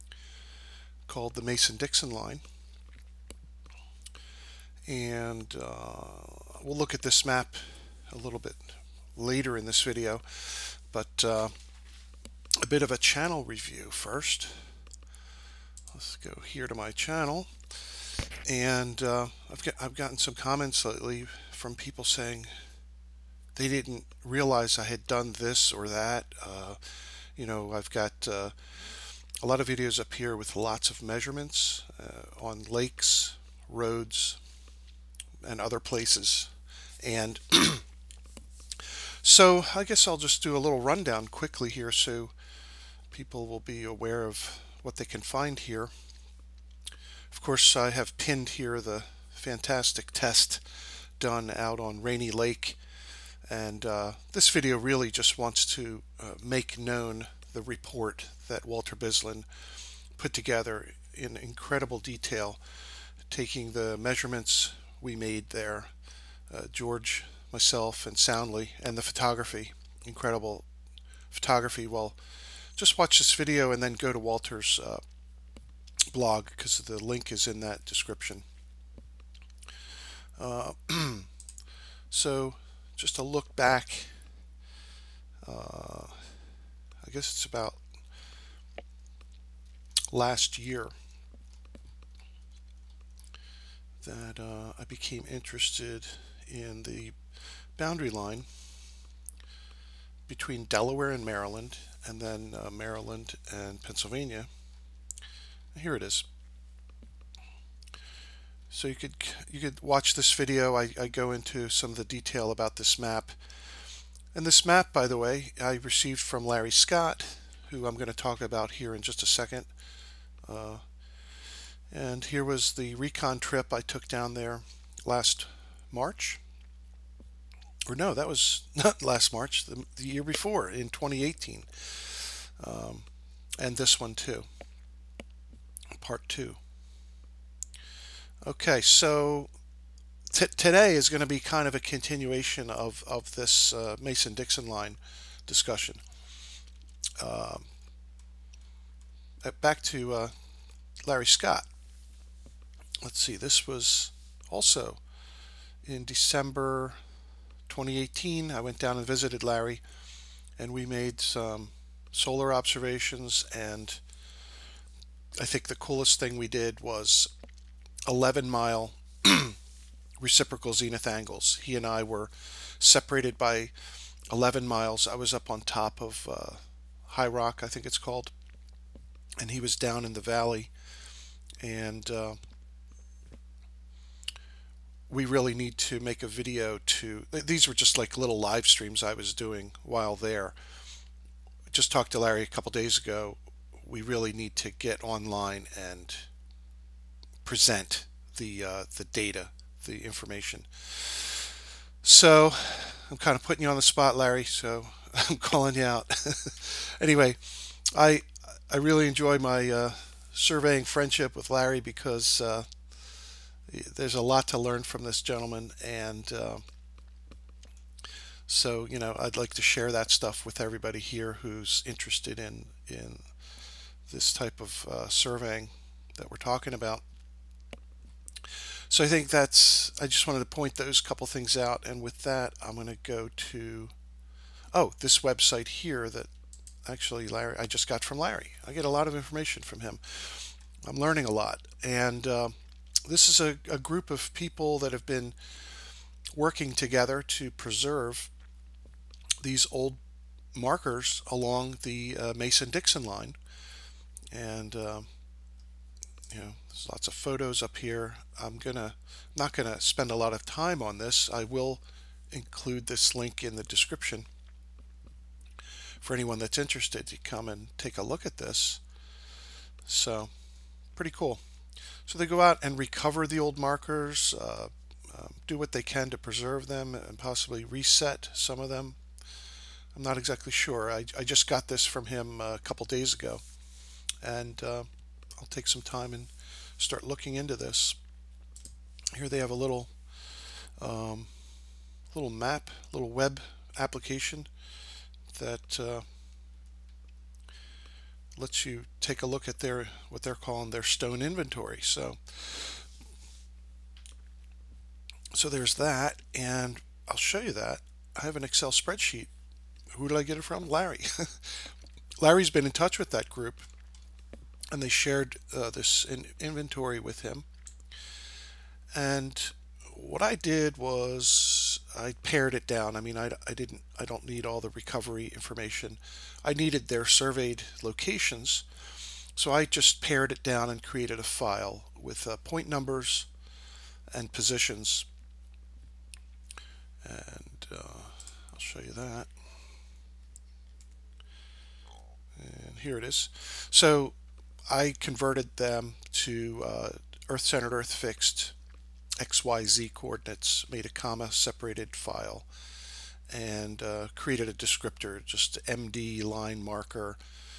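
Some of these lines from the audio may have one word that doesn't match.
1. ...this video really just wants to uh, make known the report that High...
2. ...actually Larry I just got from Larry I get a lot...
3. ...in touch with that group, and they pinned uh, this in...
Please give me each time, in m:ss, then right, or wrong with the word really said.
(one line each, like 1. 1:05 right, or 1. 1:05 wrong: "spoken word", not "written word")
1. 0:54 wrong: "Walter", not "High"
2. 3:56 right
3. 5:12 wrong: "shared", not "pinned".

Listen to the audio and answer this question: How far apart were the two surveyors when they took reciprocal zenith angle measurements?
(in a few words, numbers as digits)
11 miles.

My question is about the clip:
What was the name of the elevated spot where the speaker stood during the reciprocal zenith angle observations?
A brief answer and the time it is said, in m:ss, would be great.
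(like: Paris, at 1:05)
High Rock, at 2:57.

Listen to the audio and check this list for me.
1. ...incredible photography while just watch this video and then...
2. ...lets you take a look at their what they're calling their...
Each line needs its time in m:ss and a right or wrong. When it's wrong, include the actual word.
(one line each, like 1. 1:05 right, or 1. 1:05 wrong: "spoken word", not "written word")
1. 1:10 right
2. 4:58 right.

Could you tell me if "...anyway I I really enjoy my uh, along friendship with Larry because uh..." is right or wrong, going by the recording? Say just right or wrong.
wrong.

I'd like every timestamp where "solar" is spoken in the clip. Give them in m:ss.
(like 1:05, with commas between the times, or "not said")
2:42.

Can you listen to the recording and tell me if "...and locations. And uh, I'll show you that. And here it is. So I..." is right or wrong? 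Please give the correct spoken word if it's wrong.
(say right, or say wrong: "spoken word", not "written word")
wrong: "positions", not "locations".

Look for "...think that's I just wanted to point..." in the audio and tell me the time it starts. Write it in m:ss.
3:49.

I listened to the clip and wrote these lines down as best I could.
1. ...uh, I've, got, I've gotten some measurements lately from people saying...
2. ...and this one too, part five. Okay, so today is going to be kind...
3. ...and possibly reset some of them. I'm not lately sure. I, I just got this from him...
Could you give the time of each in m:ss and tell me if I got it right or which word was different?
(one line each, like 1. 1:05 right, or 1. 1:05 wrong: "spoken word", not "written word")
1. 0:19 wrong: "comments", not "measurements"
2. 2:13 wrong: "two", not "five"
3. 4:36 wrong: "exactly", not "lately".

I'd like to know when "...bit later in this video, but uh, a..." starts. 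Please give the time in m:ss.
0:08.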